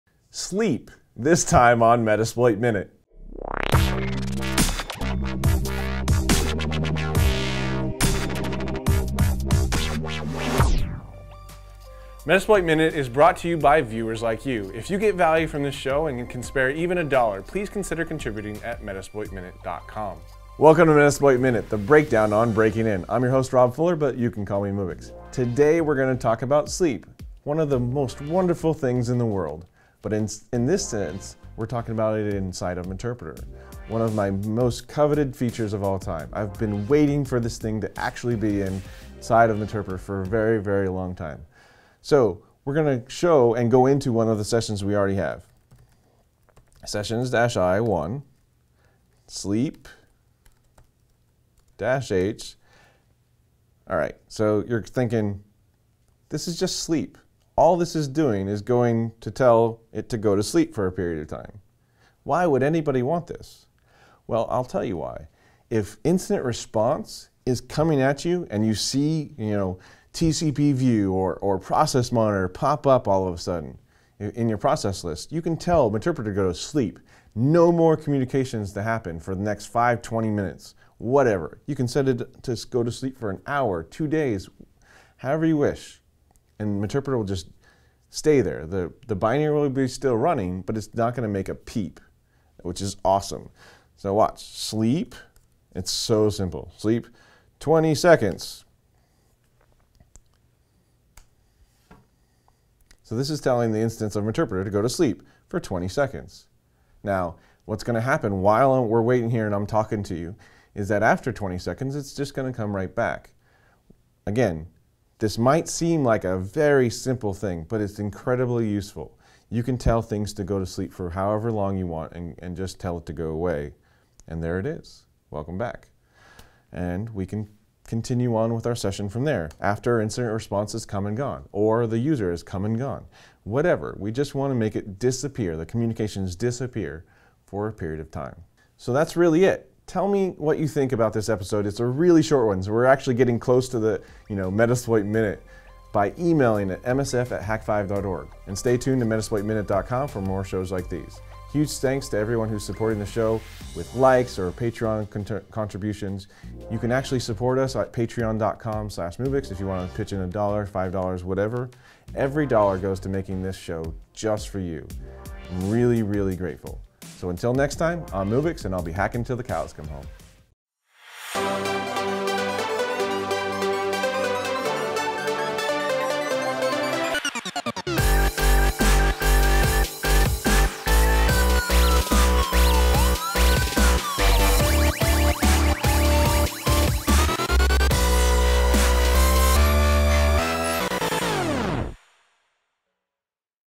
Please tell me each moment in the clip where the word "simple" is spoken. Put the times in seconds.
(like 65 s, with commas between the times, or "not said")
96 s, 116 s.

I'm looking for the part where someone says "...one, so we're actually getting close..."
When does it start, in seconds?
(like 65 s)
142 s.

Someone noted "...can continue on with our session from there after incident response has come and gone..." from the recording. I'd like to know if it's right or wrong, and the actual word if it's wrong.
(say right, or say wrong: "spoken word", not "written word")
right.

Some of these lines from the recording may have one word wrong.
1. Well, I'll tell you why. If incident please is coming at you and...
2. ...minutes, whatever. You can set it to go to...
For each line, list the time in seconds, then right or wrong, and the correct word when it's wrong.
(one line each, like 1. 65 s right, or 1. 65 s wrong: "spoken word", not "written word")
1. 64 s wrong: "response", not "please"
2. 80 s right.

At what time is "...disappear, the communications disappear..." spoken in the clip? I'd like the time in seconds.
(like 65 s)
134 s.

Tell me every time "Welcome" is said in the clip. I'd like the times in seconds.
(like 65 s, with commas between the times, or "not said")
20 s, 125 s.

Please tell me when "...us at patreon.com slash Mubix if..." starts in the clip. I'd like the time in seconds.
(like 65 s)
157 s.